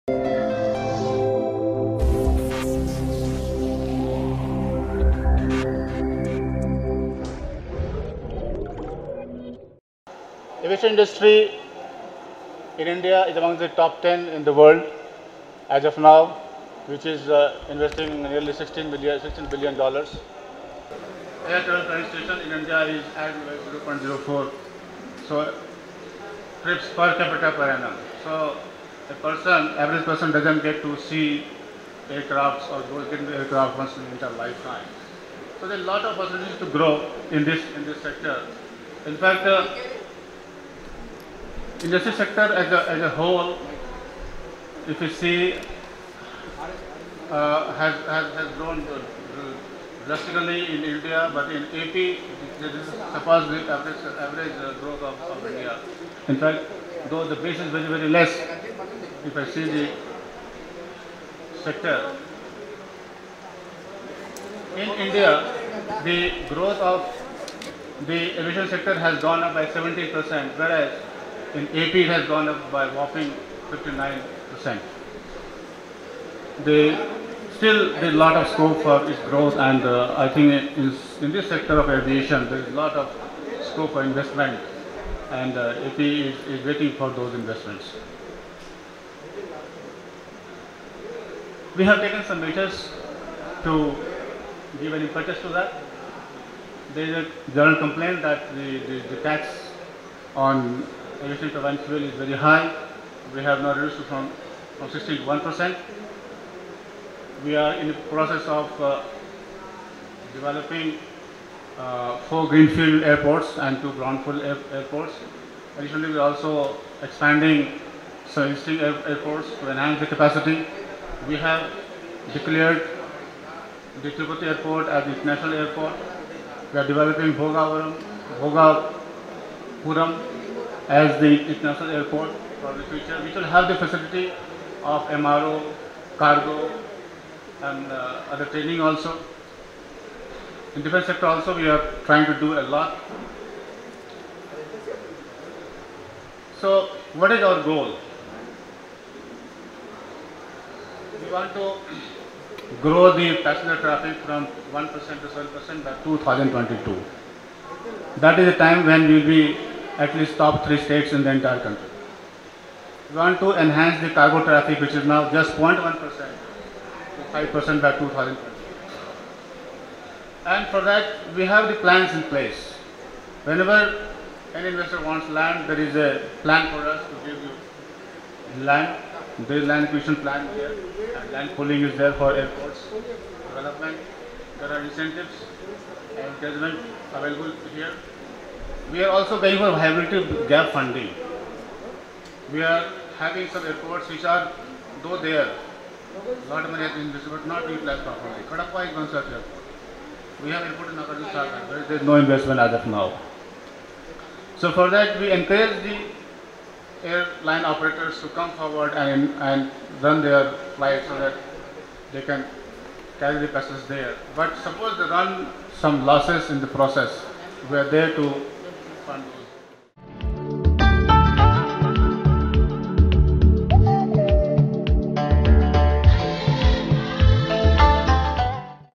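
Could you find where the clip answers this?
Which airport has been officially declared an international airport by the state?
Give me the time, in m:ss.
2:04.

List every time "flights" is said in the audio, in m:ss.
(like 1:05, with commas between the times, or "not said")
3:30.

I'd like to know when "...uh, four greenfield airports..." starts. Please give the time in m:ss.
1:51.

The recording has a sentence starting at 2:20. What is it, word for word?
In defense sector also, we are trying to do a lot.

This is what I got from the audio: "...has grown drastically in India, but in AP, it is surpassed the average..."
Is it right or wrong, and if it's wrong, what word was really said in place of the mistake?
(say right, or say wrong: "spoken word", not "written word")
right.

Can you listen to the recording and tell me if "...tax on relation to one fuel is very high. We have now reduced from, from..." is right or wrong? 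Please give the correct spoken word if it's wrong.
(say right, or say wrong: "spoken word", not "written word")
right.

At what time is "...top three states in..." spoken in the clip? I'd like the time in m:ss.
2:40.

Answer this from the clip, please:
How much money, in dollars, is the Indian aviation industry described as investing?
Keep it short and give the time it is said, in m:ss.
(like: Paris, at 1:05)
16 billion dollars, at 0:19.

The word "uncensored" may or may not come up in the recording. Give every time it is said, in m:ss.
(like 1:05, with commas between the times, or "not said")
not said.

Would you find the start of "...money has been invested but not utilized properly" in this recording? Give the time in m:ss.
3:16.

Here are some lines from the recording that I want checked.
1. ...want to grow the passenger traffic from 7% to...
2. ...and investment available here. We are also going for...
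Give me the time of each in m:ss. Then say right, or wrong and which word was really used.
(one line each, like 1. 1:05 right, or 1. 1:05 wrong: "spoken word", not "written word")
1. 2:31 wrong: "1", not "7"
2. 3:06 wrong: "judgment", not "investment".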